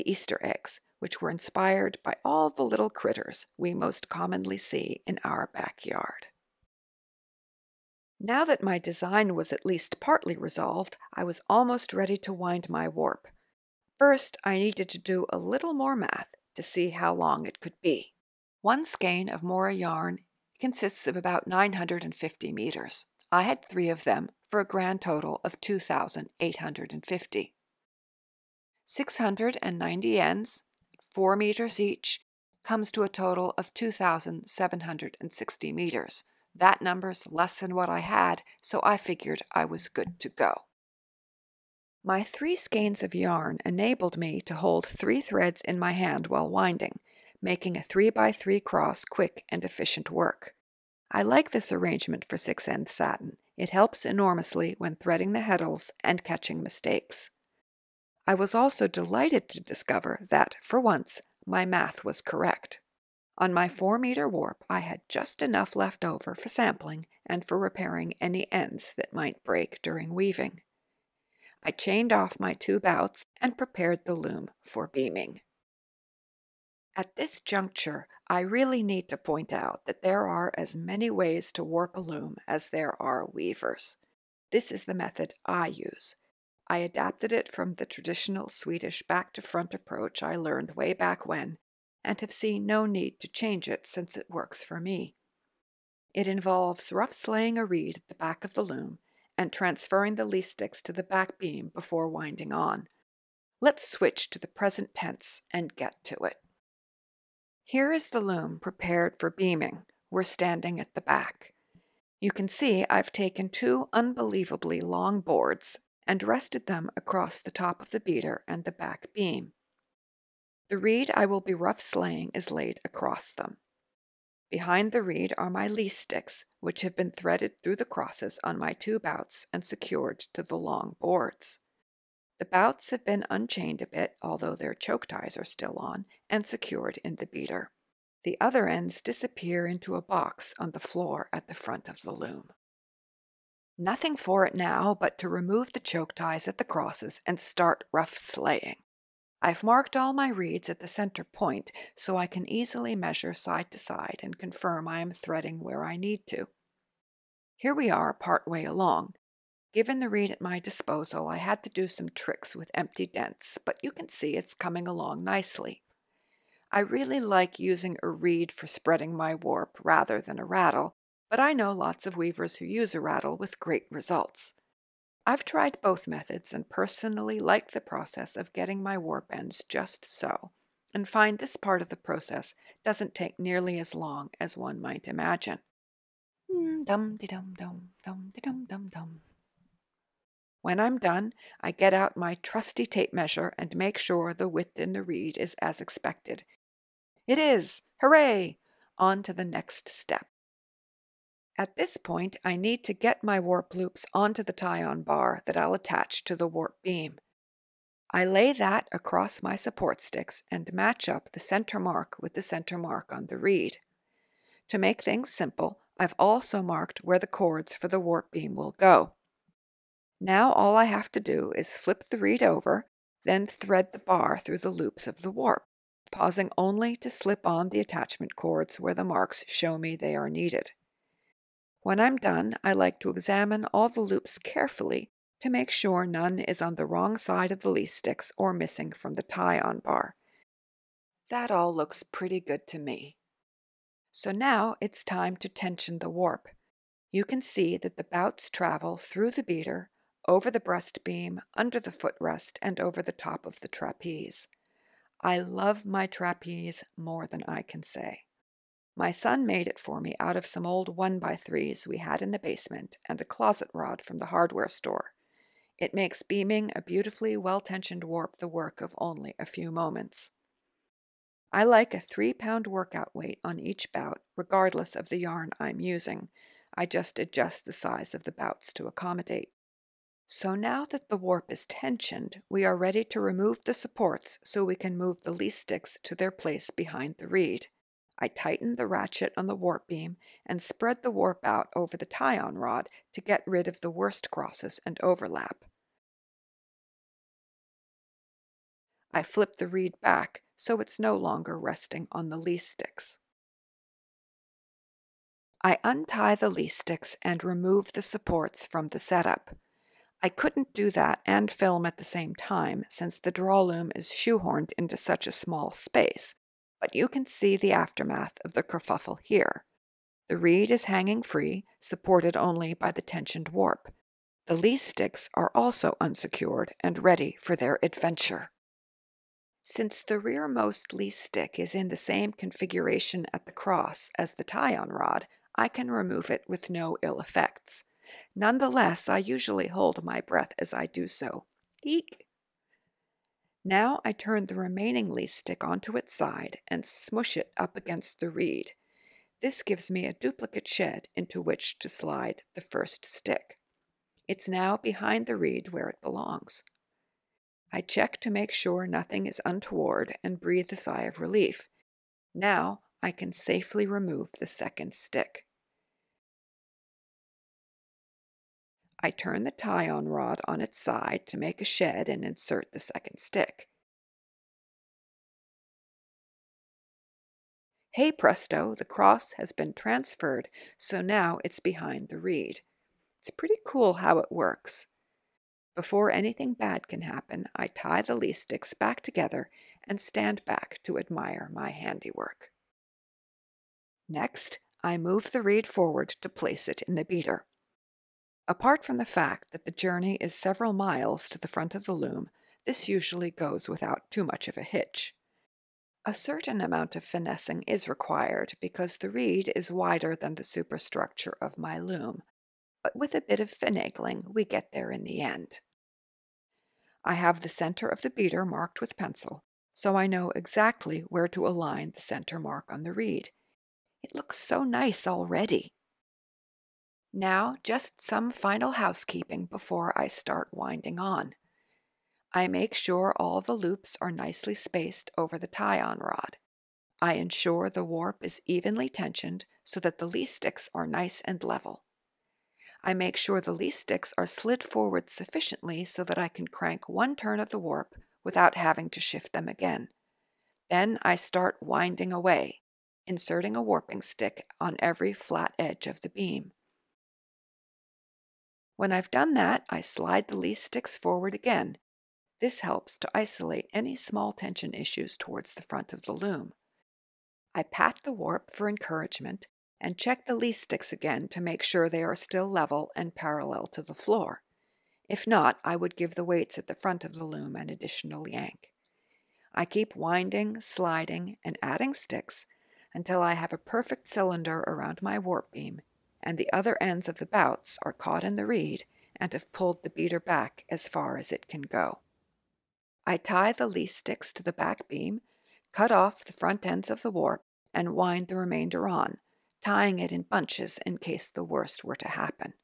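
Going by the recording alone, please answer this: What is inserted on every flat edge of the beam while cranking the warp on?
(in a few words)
a warping stick.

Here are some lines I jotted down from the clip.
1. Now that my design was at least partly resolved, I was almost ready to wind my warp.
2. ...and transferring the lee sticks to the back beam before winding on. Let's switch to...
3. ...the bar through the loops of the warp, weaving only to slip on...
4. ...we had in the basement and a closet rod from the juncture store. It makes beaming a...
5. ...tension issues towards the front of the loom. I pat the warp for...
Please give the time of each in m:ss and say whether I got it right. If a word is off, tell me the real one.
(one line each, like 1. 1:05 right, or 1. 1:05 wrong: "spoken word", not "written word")
1. 0:08 right
2. 1:39 right
3. 3:43 wrong: "pausing", not "weaving"
4. 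4:21 wrong: "hardware", not "juncture"
5. 7:44 right.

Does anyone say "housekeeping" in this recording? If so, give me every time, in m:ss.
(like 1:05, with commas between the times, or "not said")
7:08.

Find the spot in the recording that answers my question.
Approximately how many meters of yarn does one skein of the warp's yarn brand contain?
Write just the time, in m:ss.
0:21.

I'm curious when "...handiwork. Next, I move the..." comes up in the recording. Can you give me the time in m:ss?
6:31.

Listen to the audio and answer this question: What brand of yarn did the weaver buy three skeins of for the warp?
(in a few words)
Mora.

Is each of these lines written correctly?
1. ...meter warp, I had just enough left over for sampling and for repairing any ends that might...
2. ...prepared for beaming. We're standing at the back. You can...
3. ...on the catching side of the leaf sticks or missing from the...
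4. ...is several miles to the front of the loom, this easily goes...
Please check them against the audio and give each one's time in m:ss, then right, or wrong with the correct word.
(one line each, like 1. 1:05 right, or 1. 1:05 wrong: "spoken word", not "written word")
1. 1:03 right
2. 1:48 right
3. 3:56 wrong: "wrong", not "catching"
4. 6:40 wrong: "usually", not "easily".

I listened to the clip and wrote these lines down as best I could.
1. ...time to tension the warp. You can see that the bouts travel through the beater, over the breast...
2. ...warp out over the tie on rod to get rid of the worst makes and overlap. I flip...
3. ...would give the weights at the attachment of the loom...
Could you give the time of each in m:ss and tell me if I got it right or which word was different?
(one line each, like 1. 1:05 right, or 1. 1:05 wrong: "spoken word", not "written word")
1. 4:05 right
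2. 4:51 wrong: "crosses", not "makes"
3. 7:55 wrong: "front", not "attachment".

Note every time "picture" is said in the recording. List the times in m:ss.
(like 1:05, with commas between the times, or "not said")
not said.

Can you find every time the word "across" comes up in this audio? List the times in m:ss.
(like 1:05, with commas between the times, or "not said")
1:56, 2:02, 3:28.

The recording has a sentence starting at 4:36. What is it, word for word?
I just adjust the size of the bouts to accommodate.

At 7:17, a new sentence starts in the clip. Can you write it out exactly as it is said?
I ensure the warp is evenly tensioned so that the lee sticks are nice and level.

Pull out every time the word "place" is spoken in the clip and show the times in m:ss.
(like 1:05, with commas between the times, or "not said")
4:46, 6:36.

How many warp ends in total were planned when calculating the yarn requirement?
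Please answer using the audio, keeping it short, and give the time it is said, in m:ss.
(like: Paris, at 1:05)
690, at 0:28.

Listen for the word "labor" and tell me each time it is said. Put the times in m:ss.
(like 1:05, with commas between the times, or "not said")
not said.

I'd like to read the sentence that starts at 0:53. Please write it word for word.
It helps enormously when threading the heddles and catching mistakes.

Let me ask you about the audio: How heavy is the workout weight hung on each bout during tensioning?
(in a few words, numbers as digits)
3 pounds.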